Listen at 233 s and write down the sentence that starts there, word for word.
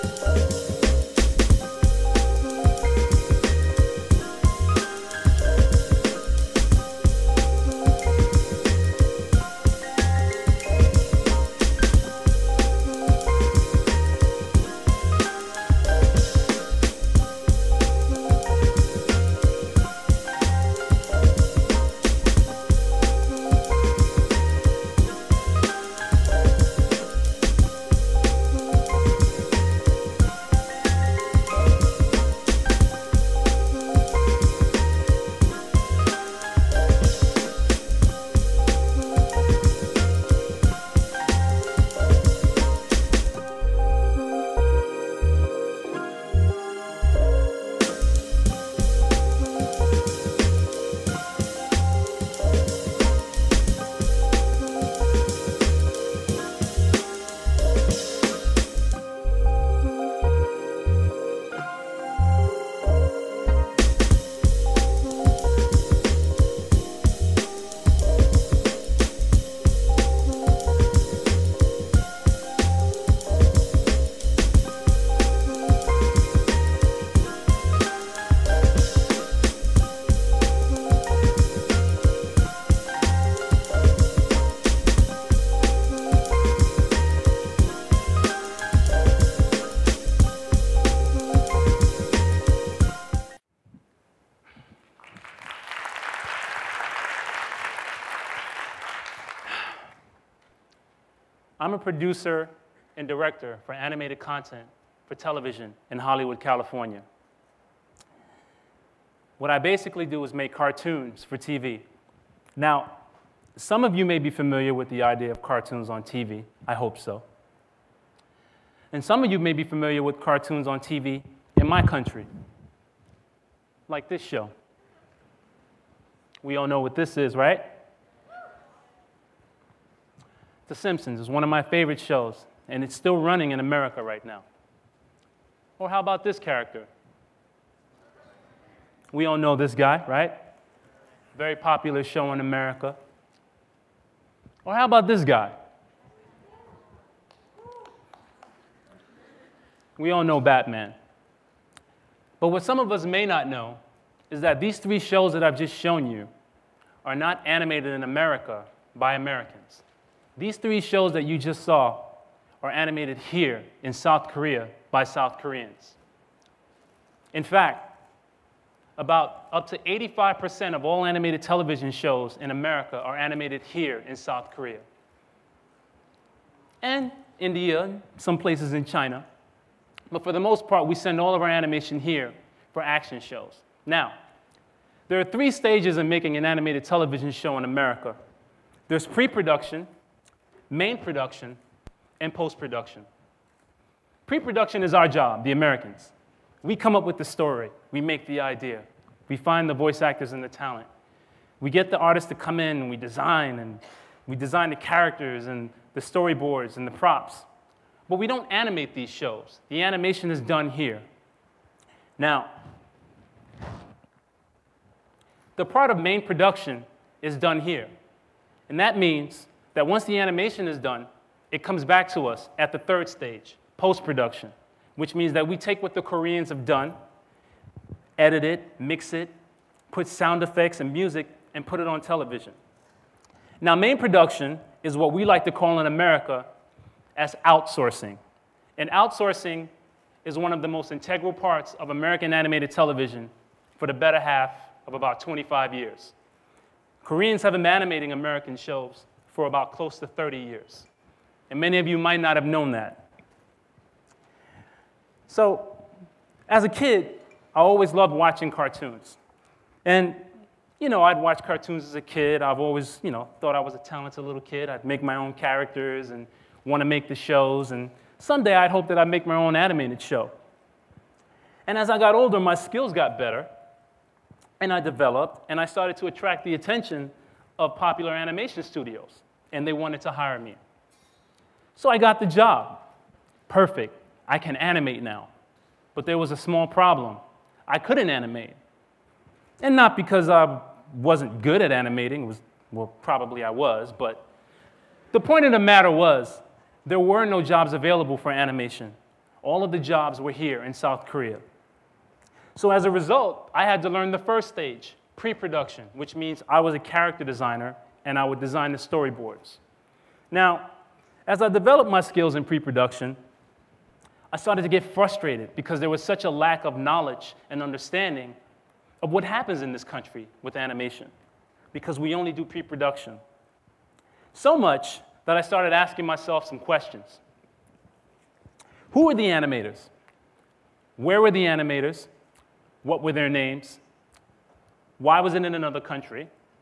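Now, main production is what we like to call in America as outsourcing.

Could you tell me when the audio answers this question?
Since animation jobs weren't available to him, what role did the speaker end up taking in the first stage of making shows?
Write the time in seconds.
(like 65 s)
306 s.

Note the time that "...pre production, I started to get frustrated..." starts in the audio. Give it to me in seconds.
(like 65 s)
312 s.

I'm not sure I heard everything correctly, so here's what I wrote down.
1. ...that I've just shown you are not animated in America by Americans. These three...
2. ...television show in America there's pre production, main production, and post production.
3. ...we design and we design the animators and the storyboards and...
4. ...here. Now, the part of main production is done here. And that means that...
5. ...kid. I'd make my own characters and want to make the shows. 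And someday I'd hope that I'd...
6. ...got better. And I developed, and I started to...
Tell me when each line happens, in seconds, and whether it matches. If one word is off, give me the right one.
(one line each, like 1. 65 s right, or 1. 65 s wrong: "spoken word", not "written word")
1. 155 s right
2. 186 s right
3. 202 s wrong: "characters", not "animators"
4. 210 s right
5. 264 s right
6. 272 s right.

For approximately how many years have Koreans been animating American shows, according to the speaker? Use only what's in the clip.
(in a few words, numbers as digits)
close to 30 years.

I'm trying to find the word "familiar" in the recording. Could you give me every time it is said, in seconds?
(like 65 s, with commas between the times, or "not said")
114 s, 119 s.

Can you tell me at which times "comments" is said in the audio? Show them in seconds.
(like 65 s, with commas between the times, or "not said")
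not said.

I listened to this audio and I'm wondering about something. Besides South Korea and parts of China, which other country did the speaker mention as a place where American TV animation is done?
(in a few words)
India.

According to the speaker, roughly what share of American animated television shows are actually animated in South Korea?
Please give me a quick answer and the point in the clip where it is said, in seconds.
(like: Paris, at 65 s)
85%, at 169 s.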